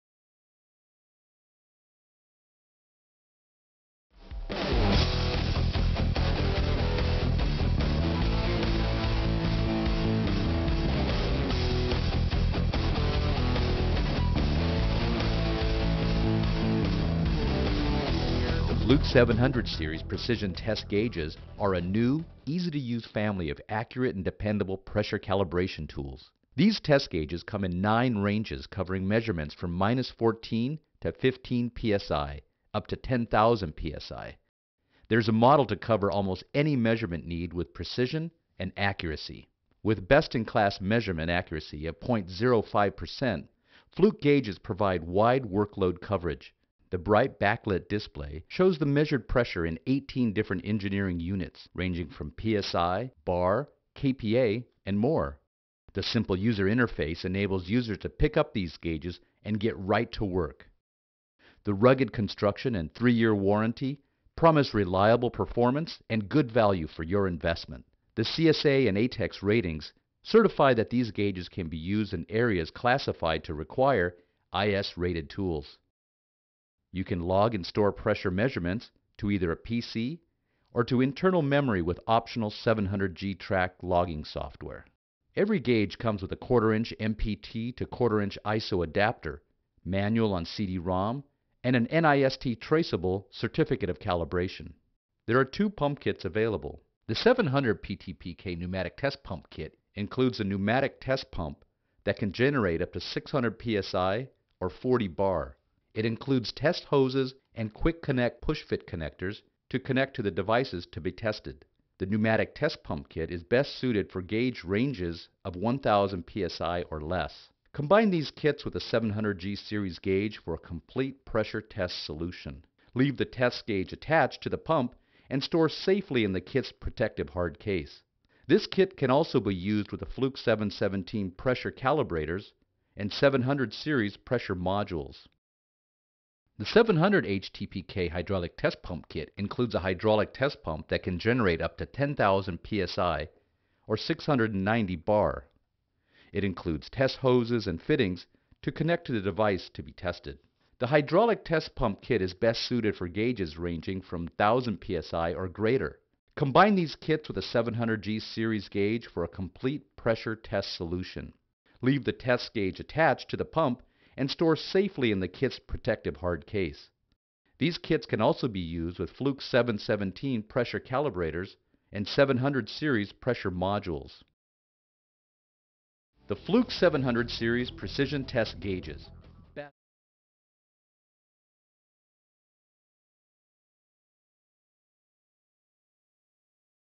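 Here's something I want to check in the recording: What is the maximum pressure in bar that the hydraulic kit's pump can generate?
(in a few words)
690 bar.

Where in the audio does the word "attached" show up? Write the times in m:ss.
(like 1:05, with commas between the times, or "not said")
2:03, 2:42.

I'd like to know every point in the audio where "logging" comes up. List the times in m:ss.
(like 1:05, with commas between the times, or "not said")
1:23.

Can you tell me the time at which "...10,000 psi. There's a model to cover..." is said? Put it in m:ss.
0:32.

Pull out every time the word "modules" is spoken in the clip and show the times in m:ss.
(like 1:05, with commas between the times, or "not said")
2:14, 2:53.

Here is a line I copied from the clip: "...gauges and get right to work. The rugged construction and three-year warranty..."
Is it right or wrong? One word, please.
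right.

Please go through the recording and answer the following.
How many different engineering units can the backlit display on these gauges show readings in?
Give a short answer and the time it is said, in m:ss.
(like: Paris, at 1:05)
18, at 0:49.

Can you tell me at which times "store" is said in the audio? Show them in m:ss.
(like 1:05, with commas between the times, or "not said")
1:17, 2:05, 2:44.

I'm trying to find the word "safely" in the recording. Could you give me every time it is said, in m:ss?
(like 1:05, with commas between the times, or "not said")
2:05, 2:44.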